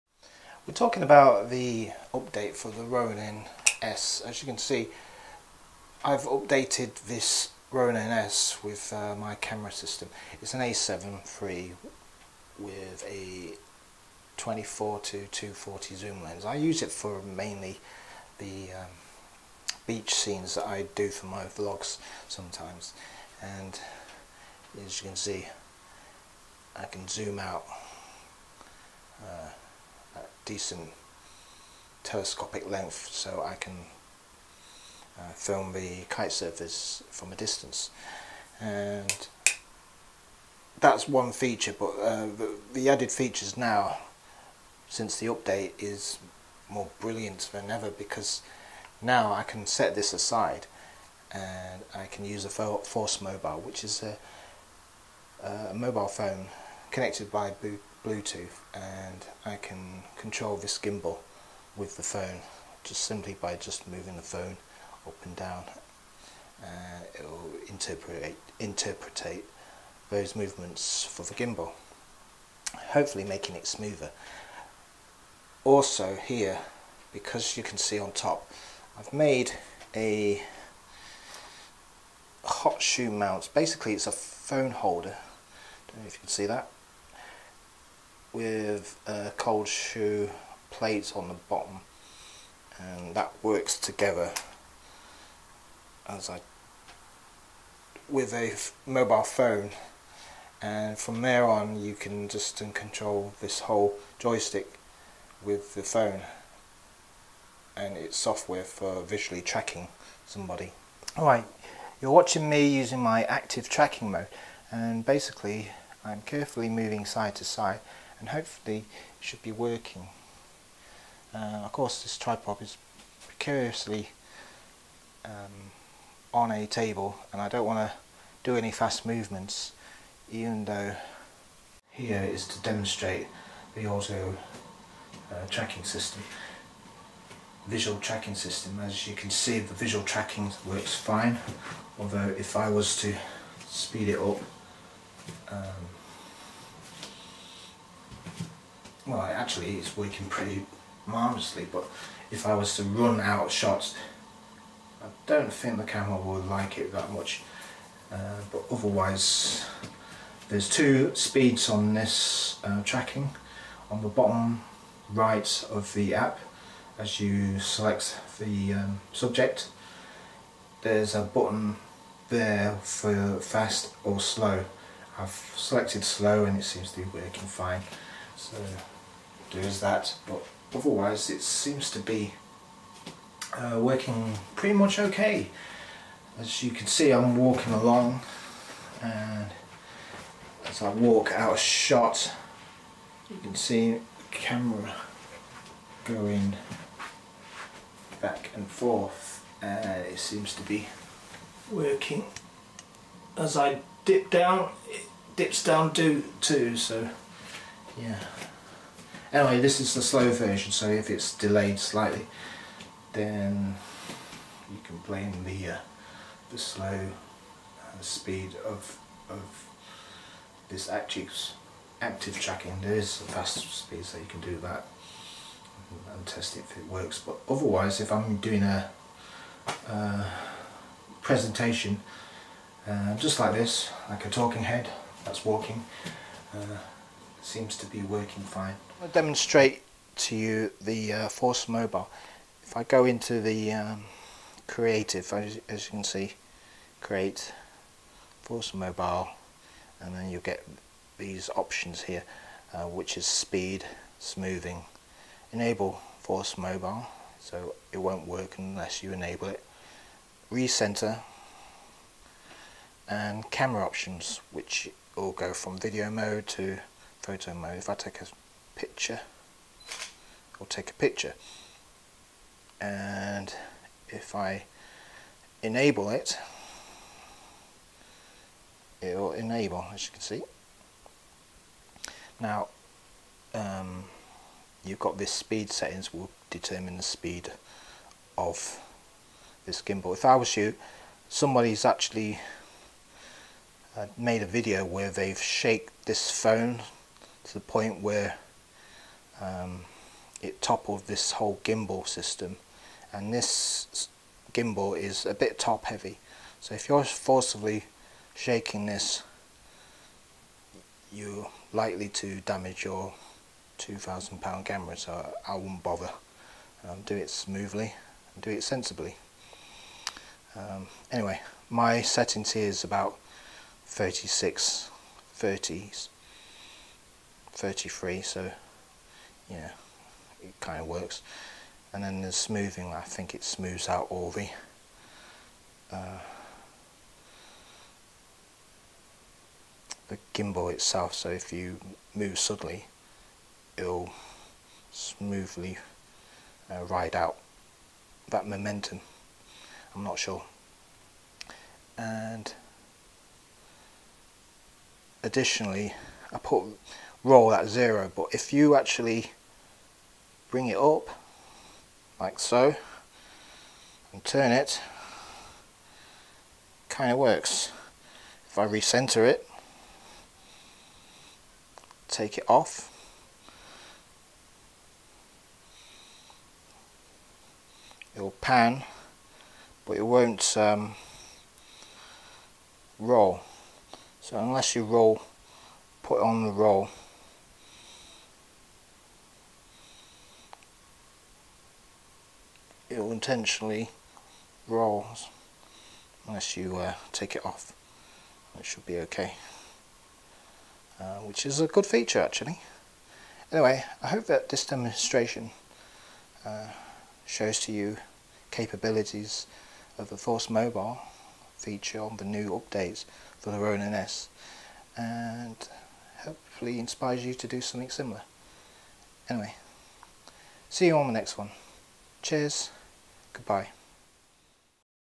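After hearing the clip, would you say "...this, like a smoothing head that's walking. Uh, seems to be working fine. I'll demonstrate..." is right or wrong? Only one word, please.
wrong.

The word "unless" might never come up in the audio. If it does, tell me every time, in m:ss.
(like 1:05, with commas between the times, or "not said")
4:18, 6:24, 6:36.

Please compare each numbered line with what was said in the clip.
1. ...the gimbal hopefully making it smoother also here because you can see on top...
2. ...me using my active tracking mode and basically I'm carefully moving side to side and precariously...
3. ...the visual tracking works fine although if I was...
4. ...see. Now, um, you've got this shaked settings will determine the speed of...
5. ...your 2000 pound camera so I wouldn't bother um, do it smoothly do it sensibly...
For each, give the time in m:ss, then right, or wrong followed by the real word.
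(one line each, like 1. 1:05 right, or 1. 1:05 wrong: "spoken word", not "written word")
1. 1:11 right
2. 1:52 wrong: "hopefully", not "precariously"
3. 2:19 right
4. 4:40 wrong: "speed", not "shaked"
5. 5:12 right.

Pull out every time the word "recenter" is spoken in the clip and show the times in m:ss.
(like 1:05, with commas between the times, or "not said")
4:20, 6:08.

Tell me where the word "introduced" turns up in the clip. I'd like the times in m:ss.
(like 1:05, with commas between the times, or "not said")
not said.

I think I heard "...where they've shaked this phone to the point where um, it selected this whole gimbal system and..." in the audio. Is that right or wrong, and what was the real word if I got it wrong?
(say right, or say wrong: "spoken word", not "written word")
wrong: "toppled", not "selected".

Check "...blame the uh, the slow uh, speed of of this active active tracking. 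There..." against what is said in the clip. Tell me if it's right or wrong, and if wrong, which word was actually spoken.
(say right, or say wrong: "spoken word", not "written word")
right.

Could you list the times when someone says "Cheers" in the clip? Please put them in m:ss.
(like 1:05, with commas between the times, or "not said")
7:02.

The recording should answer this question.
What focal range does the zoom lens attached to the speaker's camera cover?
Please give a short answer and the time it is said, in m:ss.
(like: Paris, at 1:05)
24 to 240, at 0:14.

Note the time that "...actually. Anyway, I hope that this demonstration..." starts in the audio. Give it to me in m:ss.
6:42.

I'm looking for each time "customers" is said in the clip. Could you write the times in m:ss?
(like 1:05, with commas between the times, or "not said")
not said.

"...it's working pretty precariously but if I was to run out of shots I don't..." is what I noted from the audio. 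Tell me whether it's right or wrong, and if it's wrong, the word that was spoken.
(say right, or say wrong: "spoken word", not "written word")
wrong: "marvellously", not "precariously".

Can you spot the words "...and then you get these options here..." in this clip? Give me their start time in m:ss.
4:09.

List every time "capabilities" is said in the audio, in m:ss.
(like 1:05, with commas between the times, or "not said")
6:48.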